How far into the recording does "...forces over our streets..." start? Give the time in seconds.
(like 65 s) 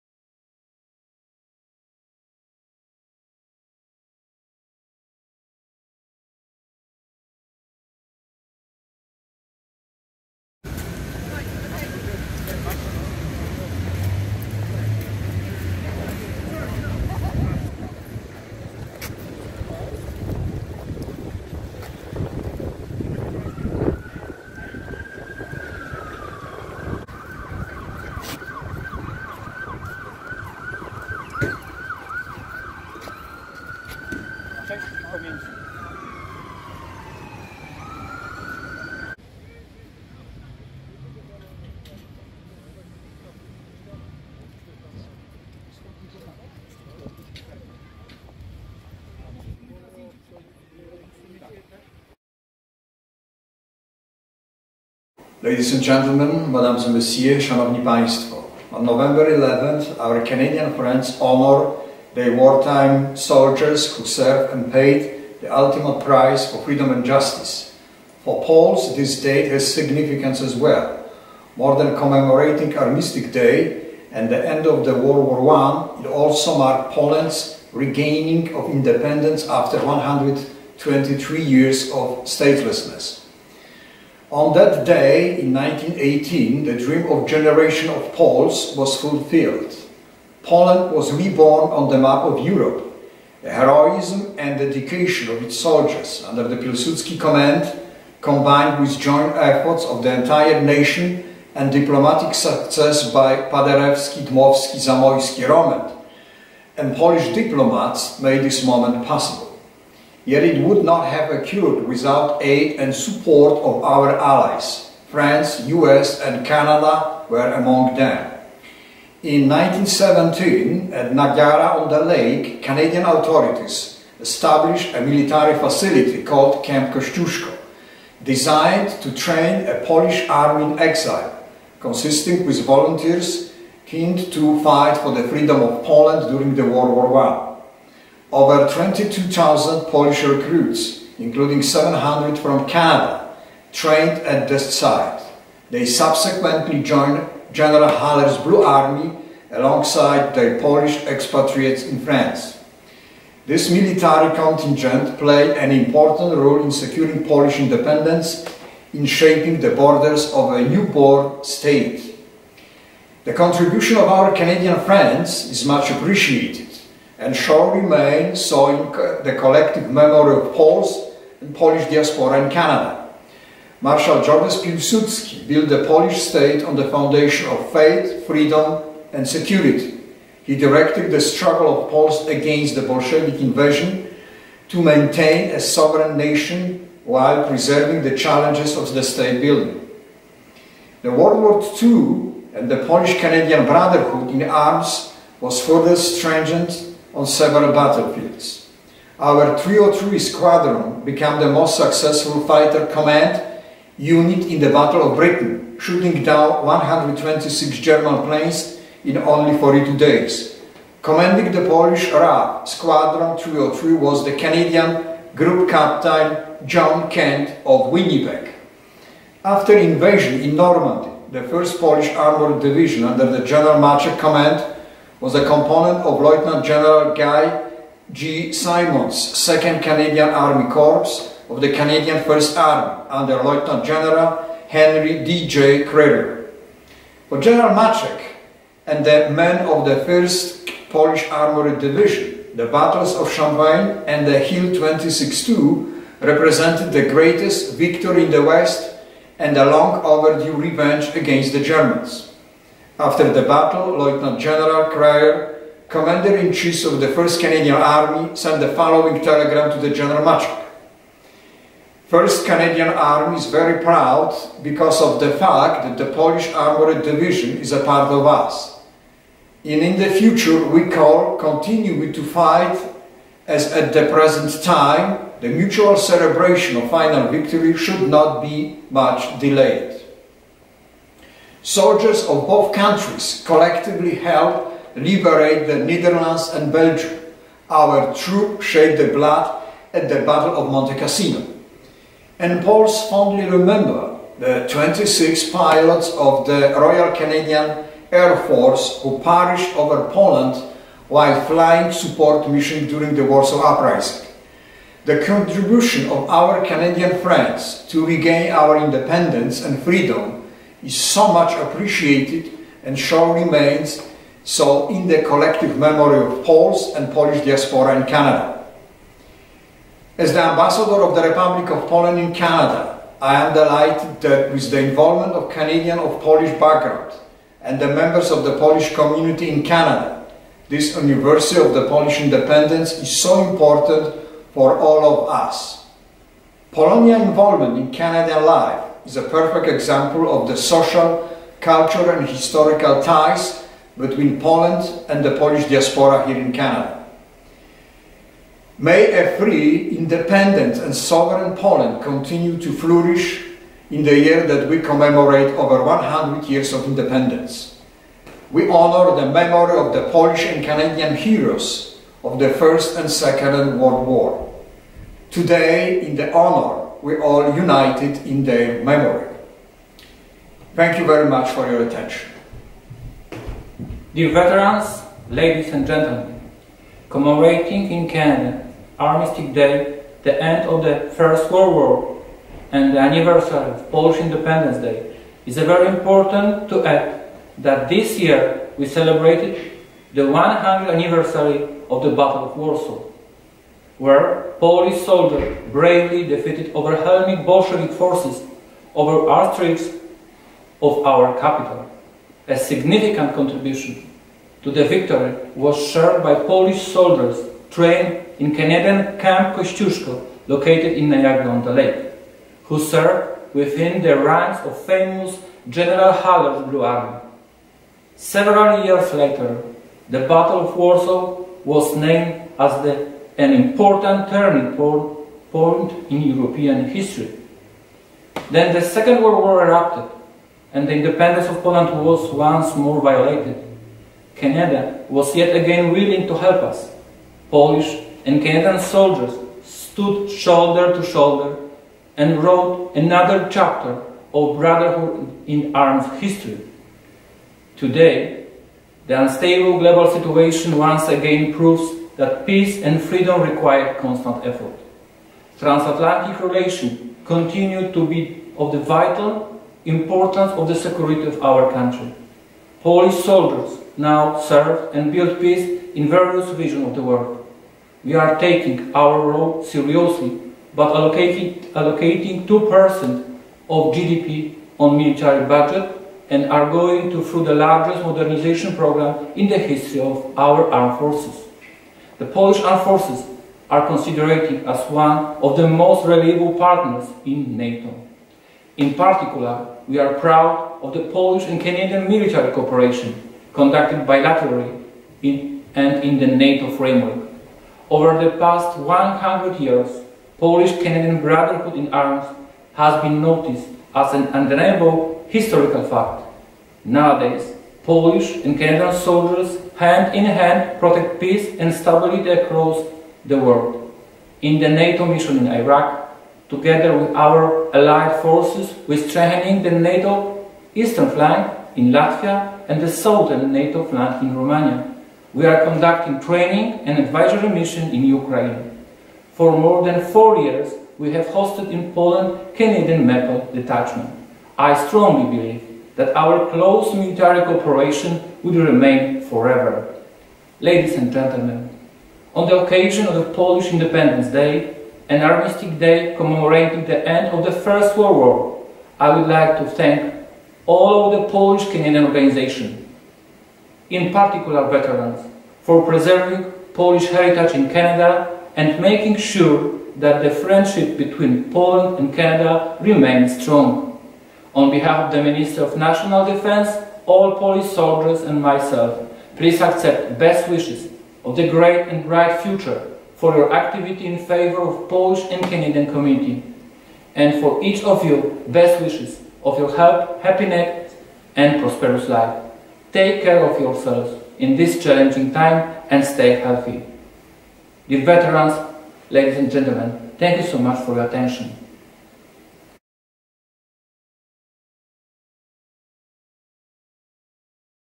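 397 s.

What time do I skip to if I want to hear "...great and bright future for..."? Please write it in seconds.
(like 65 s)
571 s.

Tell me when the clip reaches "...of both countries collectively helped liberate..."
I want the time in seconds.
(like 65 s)
282 s.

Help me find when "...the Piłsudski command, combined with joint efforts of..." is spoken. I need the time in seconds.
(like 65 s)
96 s.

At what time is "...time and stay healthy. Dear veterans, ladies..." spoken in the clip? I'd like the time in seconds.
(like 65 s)
585 s.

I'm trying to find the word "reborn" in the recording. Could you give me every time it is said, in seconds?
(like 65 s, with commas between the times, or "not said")
91 s.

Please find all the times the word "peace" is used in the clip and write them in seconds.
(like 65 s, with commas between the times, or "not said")
452 s, 465 s, 511 s.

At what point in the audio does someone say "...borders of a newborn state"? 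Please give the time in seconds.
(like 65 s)
159 s.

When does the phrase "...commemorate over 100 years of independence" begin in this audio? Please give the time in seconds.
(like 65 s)
354 s.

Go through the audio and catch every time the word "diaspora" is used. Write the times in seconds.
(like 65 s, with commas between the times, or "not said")
171 s, 317 s, 345 s.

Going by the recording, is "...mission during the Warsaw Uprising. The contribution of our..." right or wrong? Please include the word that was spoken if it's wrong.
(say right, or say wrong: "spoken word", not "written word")
right.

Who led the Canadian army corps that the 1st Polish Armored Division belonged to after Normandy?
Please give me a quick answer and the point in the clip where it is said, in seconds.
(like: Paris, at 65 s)
Guy G. Simonds, at 227 s.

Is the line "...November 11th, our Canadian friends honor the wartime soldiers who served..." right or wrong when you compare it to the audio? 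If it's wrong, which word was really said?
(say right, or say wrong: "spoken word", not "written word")
right.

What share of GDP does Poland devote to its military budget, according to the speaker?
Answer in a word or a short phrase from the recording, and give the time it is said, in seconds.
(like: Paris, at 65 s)
2%, at 472 s.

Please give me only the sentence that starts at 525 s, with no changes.
We are conducting training and advisory mission in Ukraine.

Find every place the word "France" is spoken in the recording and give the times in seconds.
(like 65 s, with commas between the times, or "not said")
115 s, 151 s.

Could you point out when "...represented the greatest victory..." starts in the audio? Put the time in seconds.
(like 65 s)
246 s.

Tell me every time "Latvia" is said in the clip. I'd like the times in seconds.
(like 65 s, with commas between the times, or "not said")
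521 s.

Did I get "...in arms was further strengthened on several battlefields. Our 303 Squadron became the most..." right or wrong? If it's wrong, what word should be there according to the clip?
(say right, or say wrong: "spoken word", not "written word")
right.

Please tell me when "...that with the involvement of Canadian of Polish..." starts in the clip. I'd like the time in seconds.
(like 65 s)
324 s.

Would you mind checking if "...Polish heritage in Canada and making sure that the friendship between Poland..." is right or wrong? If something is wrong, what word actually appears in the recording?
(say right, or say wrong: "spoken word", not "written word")
right.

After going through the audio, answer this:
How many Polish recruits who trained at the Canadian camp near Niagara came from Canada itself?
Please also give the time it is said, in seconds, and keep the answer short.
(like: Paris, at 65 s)
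700, at 141 s.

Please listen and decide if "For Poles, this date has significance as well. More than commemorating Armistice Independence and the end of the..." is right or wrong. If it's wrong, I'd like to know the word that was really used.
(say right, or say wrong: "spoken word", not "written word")
wrong: "Day", not "Independence".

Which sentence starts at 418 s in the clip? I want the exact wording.
Several years later, the Battle of Warsaw was named as the an important turning point in European history.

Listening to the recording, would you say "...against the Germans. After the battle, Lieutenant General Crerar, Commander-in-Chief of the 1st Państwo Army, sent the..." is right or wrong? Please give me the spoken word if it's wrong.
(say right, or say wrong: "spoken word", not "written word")
wrong: "Canadian", not "Państwo".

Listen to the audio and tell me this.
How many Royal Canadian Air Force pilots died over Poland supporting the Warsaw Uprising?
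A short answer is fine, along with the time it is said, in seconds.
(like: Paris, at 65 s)
26, at 294 s.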